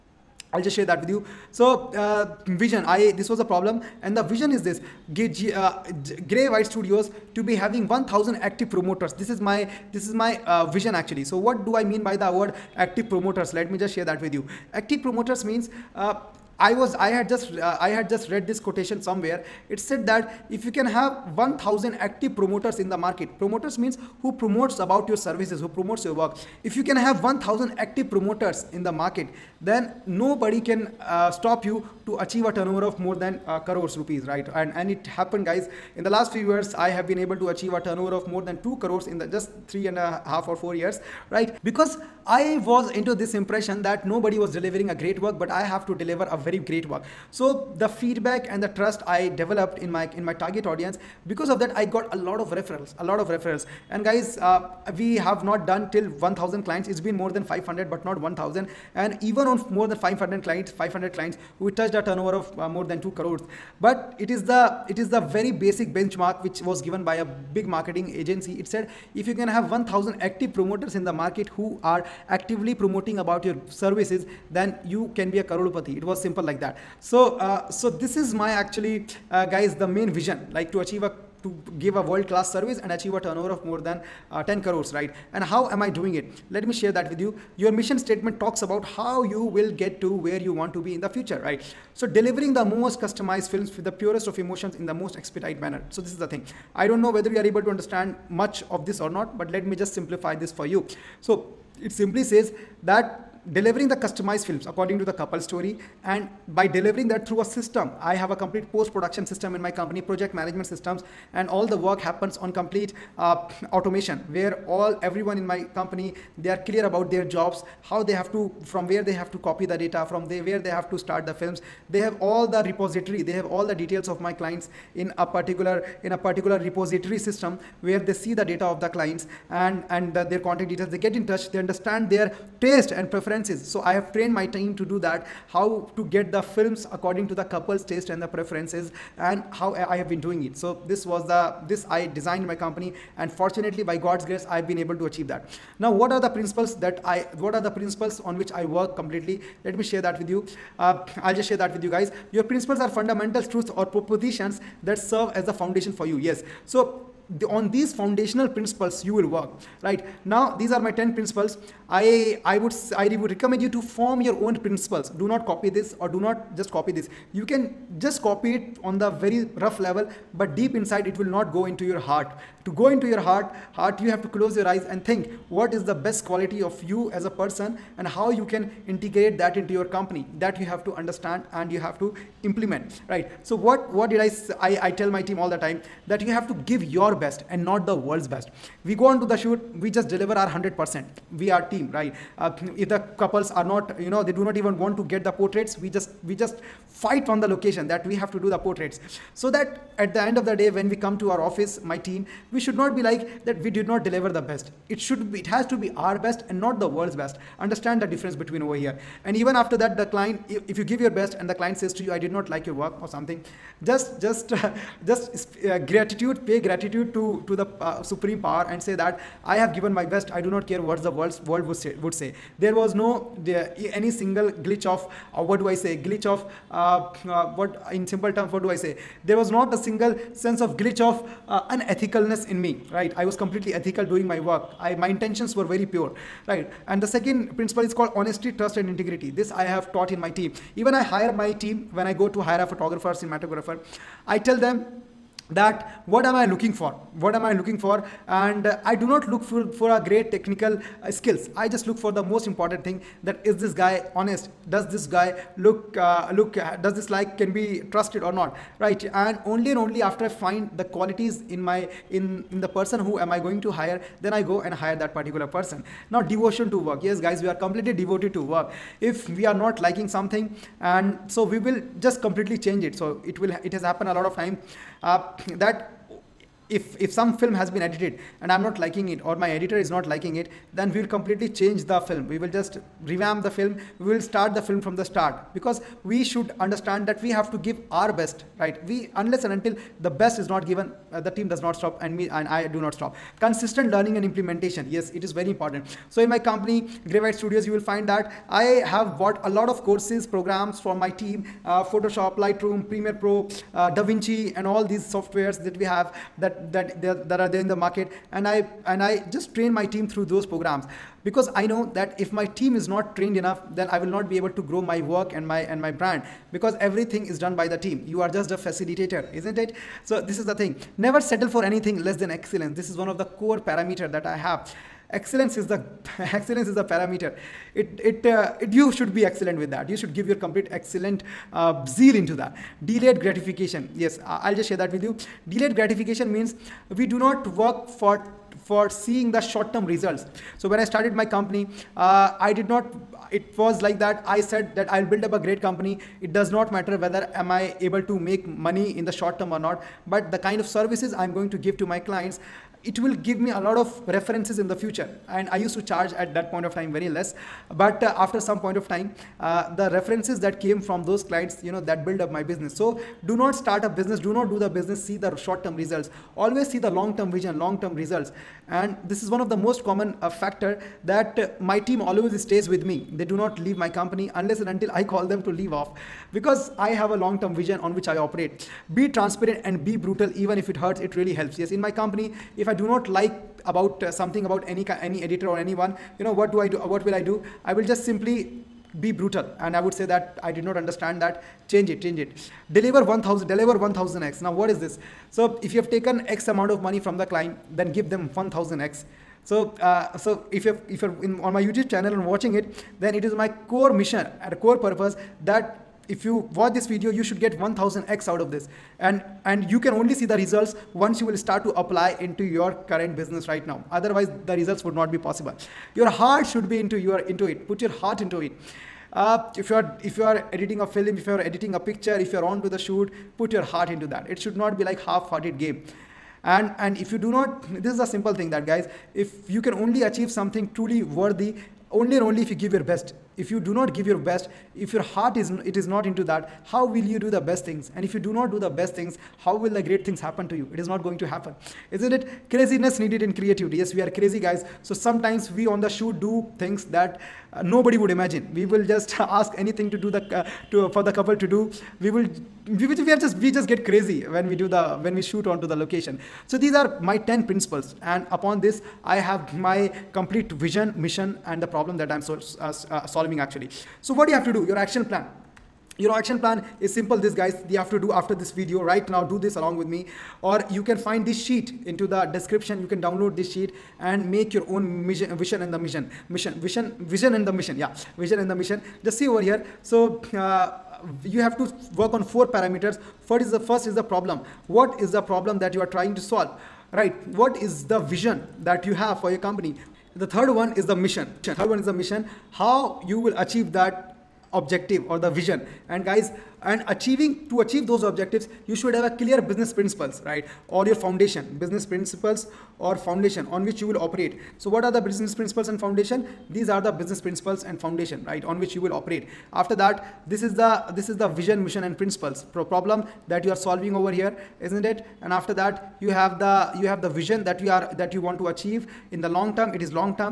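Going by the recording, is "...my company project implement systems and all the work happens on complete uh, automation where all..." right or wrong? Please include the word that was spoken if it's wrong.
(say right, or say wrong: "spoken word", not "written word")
wrong: "management", not "implement".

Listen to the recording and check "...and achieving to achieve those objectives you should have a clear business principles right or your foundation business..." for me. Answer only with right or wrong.
right.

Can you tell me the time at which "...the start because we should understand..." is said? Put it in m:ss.
4:45.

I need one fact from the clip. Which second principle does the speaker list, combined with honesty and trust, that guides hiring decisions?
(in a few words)
integrity.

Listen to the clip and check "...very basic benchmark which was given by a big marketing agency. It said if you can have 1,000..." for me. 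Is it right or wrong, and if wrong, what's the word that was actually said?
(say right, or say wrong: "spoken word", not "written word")
right.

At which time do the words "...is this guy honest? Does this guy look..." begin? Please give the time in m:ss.
4:13.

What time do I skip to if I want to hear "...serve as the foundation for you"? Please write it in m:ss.
2:34.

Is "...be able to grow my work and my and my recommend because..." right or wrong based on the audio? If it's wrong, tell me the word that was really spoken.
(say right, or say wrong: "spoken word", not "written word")
wrong: "brand", not "recommend".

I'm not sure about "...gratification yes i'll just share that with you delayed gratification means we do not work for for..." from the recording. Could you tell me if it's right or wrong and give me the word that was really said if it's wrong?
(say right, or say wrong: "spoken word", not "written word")
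right.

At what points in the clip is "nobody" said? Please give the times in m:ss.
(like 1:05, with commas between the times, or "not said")
0:30, 0:44, 7:27.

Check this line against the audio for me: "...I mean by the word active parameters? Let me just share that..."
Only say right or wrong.
wrong.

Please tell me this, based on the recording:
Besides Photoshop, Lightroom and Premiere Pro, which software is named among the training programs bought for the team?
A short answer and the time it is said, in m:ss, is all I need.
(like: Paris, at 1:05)
DaVinci, at 5:04.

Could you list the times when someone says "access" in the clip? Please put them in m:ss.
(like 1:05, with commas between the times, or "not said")
not said.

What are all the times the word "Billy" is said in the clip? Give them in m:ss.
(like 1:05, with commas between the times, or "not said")
not said.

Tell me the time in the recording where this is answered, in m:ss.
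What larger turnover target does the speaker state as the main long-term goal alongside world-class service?
1:23.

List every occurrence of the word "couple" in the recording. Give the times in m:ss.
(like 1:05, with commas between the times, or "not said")
1:45, 2:17, 3:13, 7:31.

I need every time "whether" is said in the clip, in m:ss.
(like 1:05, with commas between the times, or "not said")
1:37, 5:46.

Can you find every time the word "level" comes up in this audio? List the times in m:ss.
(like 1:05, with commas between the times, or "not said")
2:49.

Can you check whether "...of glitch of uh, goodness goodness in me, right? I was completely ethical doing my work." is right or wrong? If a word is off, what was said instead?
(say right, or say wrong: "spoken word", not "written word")
wrong: "unethicalness", not "goodness".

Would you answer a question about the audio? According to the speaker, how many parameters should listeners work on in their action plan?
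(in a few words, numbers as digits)
4.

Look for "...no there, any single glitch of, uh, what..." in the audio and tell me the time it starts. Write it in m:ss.
3:42.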